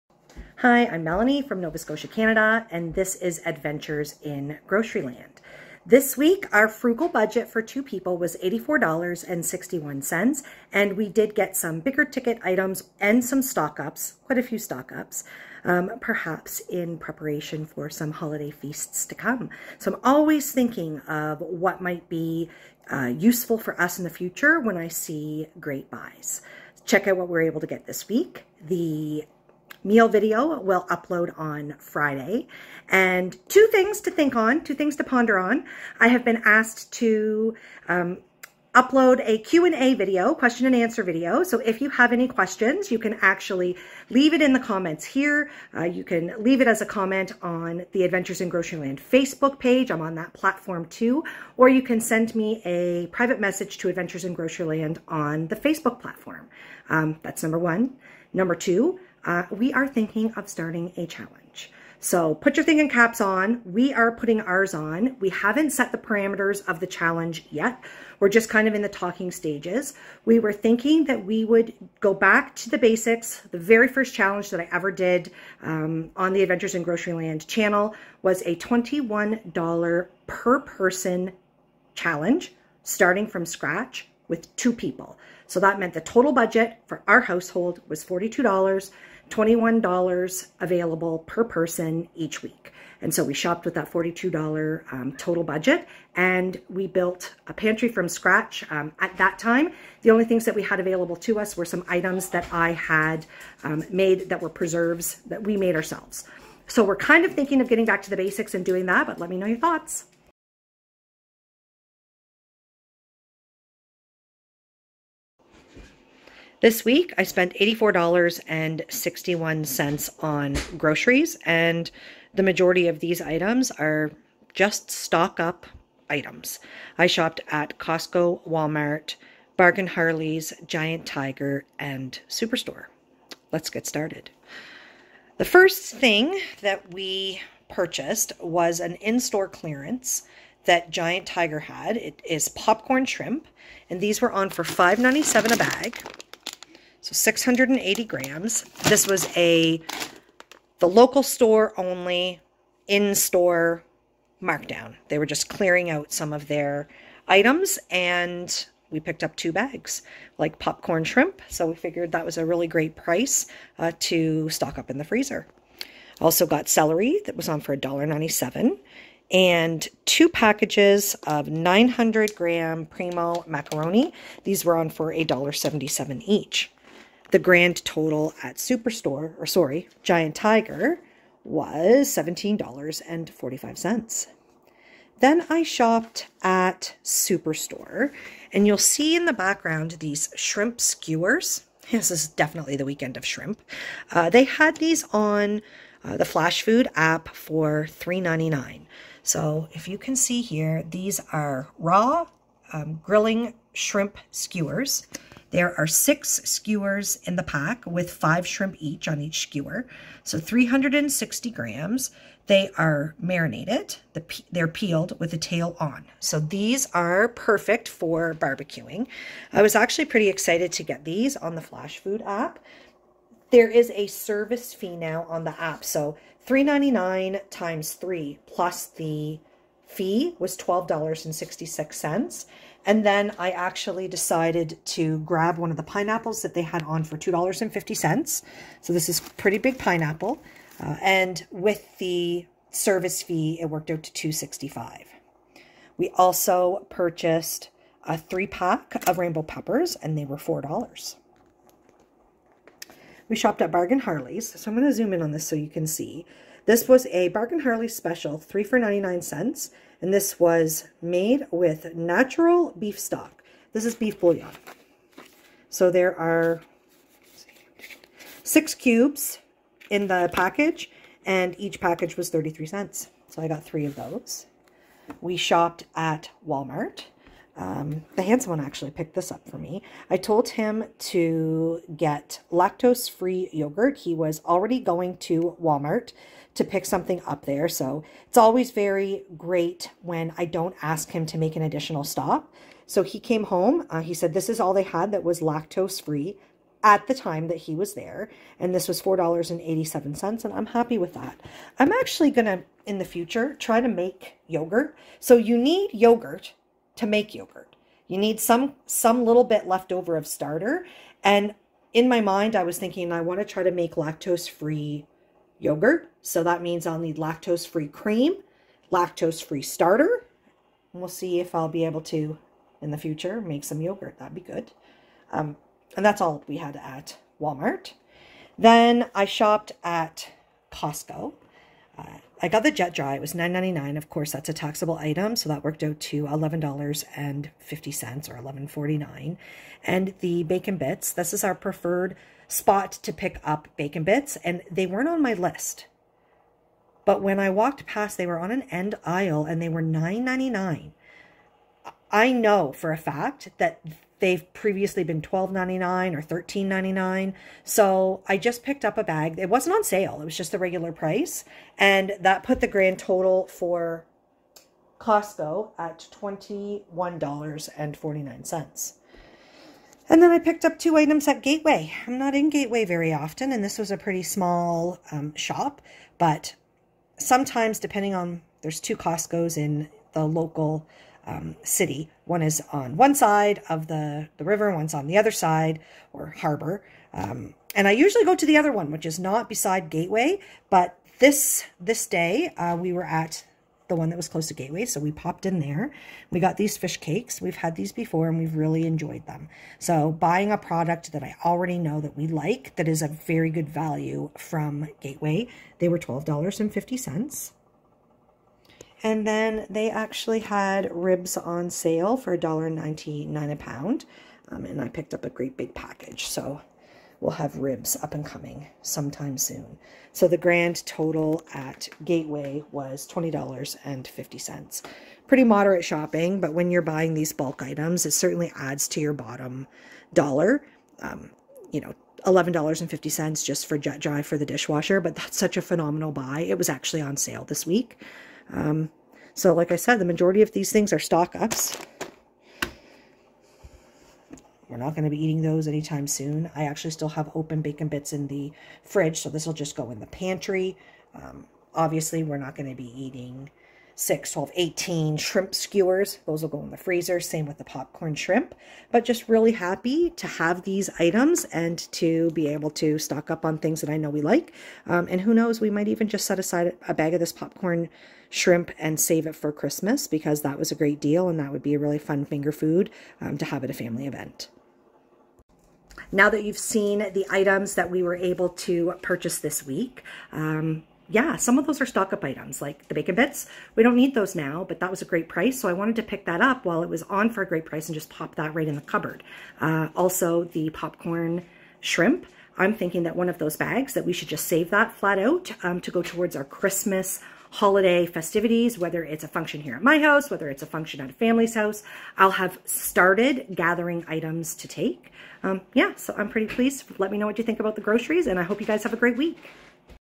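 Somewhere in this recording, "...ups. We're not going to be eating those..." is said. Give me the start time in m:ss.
7:21.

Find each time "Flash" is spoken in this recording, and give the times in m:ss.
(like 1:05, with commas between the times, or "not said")
3:16, 3:41.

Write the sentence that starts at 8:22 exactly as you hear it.
I'll have started gathering items to take.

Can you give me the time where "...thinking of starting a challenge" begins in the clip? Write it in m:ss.
0:59.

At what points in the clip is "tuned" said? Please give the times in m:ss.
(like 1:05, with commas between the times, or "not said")
not said.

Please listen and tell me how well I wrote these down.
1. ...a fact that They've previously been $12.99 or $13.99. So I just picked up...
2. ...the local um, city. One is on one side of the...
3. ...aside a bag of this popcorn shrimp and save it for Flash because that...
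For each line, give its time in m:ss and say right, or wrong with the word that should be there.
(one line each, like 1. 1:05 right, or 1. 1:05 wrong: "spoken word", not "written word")
1. 5:52 right
2. 6:20 right
3. 7:46 wrong: "Christmas", not "Flash".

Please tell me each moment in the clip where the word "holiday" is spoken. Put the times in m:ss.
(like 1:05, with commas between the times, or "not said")
0:18, 8:17.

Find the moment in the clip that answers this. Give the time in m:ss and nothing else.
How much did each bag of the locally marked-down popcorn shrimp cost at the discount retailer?
2:24.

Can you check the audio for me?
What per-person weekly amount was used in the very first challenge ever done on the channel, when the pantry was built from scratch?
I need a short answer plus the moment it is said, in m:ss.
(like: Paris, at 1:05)
$21, at 1:18.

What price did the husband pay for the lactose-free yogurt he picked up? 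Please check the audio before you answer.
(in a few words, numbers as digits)
$4.87.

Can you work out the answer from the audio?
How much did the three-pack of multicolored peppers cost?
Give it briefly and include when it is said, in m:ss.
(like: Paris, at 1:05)
$4, at 4:10.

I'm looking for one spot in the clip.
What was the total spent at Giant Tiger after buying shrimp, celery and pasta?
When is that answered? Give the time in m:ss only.
3:02.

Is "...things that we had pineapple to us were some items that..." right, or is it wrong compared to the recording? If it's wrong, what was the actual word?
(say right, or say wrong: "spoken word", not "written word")
wrong: "available", not "pineapple".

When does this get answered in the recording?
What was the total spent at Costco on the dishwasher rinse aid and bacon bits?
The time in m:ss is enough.
6:06.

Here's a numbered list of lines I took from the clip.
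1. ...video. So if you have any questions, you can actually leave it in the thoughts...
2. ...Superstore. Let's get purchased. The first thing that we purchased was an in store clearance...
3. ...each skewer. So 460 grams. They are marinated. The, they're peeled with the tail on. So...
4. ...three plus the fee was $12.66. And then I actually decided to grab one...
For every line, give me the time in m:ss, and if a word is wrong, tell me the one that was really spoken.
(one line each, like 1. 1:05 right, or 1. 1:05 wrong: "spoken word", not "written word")
1. 0:41 wrong: "comments", not "thoughts"
2. 2:12 wrong: "started", not "purchased"
3. 3:29 wrong: "360", not "460"
4. 3:47 right.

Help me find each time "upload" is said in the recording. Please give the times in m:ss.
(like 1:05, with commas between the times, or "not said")
0:30, 0:38.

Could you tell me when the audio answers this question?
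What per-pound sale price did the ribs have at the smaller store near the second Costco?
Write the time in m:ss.
6:52.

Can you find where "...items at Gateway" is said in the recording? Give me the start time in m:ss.
6:10.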